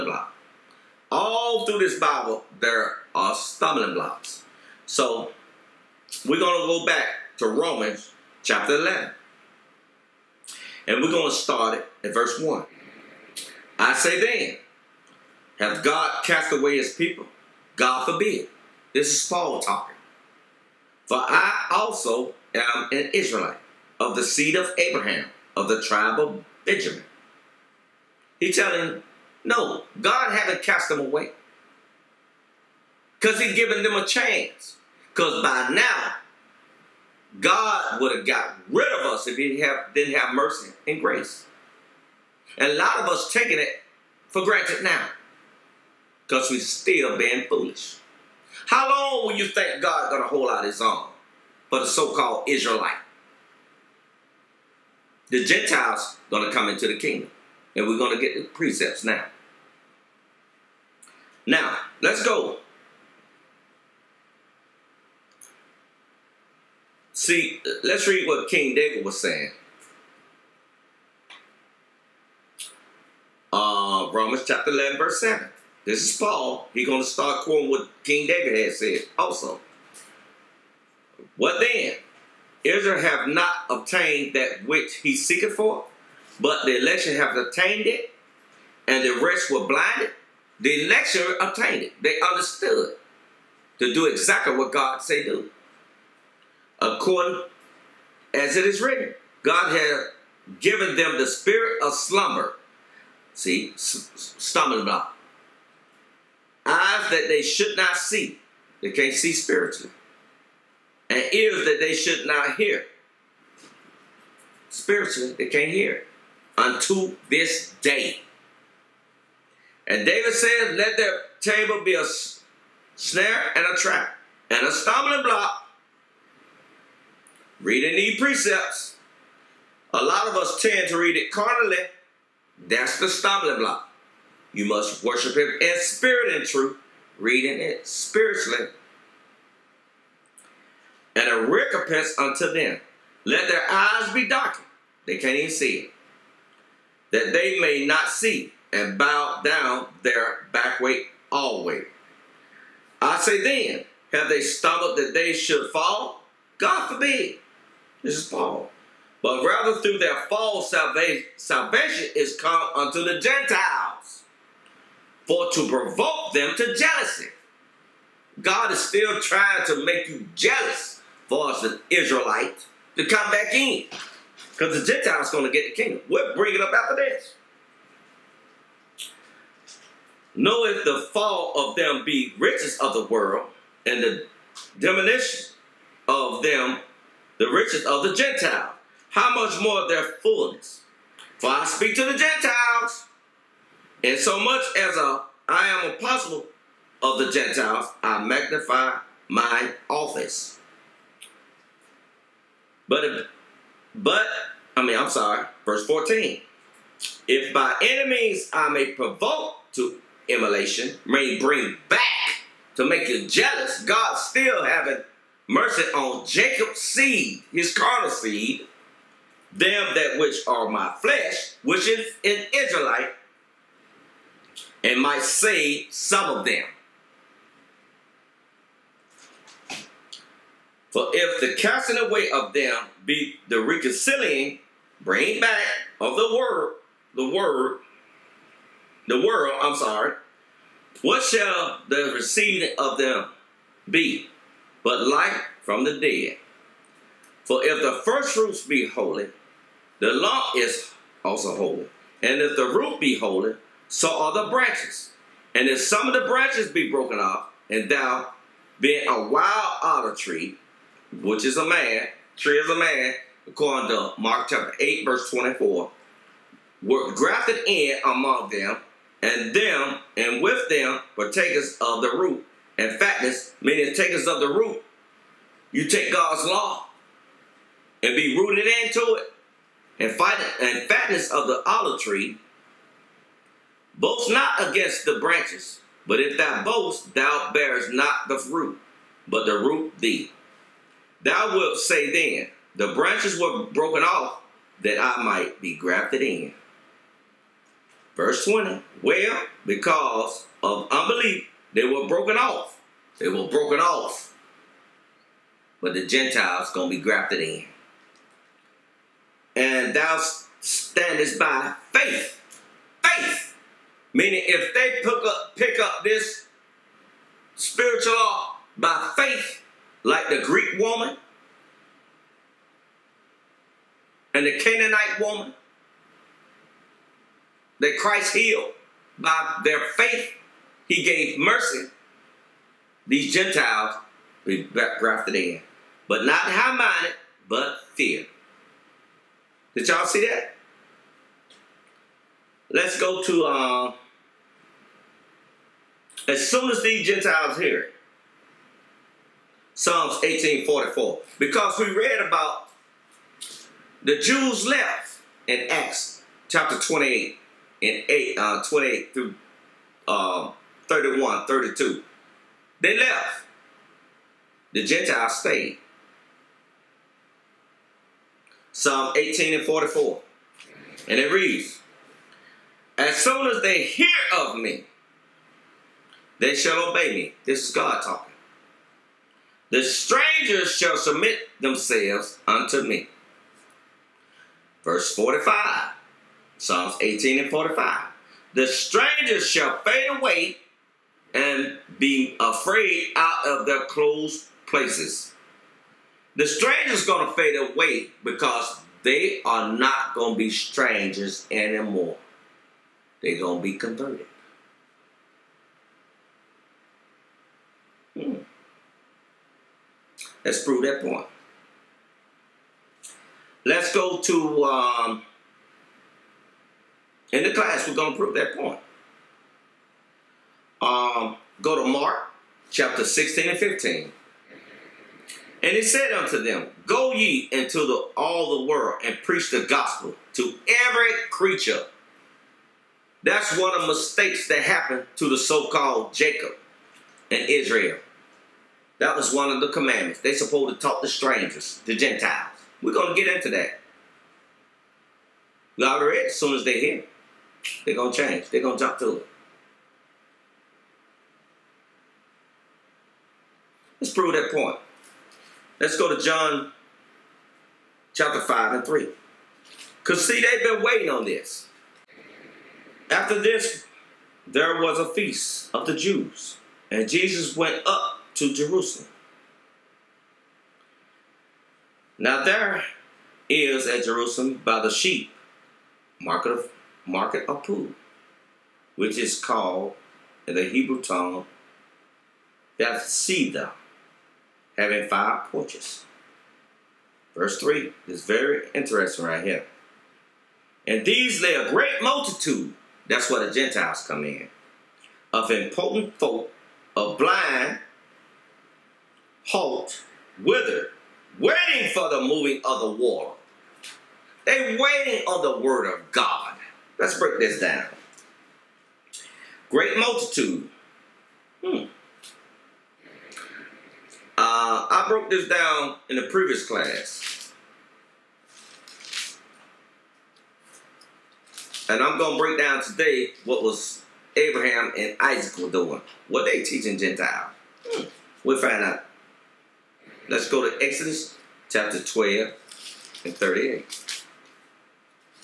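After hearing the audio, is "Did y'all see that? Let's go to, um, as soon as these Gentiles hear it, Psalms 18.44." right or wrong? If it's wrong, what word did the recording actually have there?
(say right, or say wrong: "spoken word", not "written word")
right.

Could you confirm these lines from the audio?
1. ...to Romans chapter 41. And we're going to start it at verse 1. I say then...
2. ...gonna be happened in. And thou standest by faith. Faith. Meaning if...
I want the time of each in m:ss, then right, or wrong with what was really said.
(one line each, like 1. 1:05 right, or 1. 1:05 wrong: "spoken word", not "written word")
1. 0:07 wrong: "11", not "41"
2. 5:06 wrong: "grafted", not "happened".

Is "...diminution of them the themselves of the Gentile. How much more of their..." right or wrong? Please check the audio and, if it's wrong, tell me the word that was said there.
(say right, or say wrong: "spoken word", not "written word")
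wrong: "riches", not "themselves".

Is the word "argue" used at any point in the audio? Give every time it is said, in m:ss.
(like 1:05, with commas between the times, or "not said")
not said.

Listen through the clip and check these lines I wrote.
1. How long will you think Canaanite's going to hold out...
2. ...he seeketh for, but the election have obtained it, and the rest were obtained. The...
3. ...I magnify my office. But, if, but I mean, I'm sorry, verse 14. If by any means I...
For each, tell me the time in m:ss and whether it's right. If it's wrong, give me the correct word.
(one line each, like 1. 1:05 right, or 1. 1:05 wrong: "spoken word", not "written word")
1. 0:48 wrong: "God", not "Canaanite"
2. 1:24 wrong: "blinded", not "obtained"
3. 3:18 right.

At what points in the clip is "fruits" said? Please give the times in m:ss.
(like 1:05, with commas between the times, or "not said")
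4:08, 4:48.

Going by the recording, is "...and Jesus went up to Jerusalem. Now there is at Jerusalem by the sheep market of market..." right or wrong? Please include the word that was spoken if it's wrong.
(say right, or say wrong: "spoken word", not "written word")
right.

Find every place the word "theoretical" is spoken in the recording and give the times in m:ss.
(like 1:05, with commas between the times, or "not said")
not said.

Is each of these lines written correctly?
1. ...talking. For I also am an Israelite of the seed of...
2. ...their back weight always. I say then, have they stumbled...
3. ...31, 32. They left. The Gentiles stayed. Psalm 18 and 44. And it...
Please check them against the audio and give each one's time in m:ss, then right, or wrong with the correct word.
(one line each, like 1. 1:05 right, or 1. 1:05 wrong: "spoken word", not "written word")
1. 0:19 right
2. 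2:30 right
3. 6:00 right.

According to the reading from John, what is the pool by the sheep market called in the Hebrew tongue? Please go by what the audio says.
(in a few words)
Bethsaida.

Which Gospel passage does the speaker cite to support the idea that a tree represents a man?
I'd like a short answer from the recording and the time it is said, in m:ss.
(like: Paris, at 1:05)
Mark 8:24, at 4:24.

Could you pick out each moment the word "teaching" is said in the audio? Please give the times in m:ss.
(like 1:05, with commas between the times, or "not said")
8:46.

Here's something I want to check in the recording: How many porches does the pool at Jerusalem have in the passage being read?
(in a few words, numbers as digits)
5.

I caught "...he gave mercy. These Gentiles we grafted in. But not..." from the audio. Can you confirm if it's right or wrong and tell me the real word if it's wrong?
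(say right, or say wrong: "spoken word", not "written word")
right.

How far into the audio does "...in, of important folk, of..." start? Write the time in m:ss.
8:14.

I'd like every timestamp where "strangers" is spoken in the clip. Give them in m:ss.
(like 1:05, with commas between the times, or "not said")
6:19, 6:28, 6:36, 6:40, 7:21.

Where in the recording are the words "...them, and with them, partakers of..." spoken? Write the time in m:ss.
4:29.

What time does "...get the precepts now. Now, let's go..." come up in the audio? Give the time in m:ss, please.
0:58.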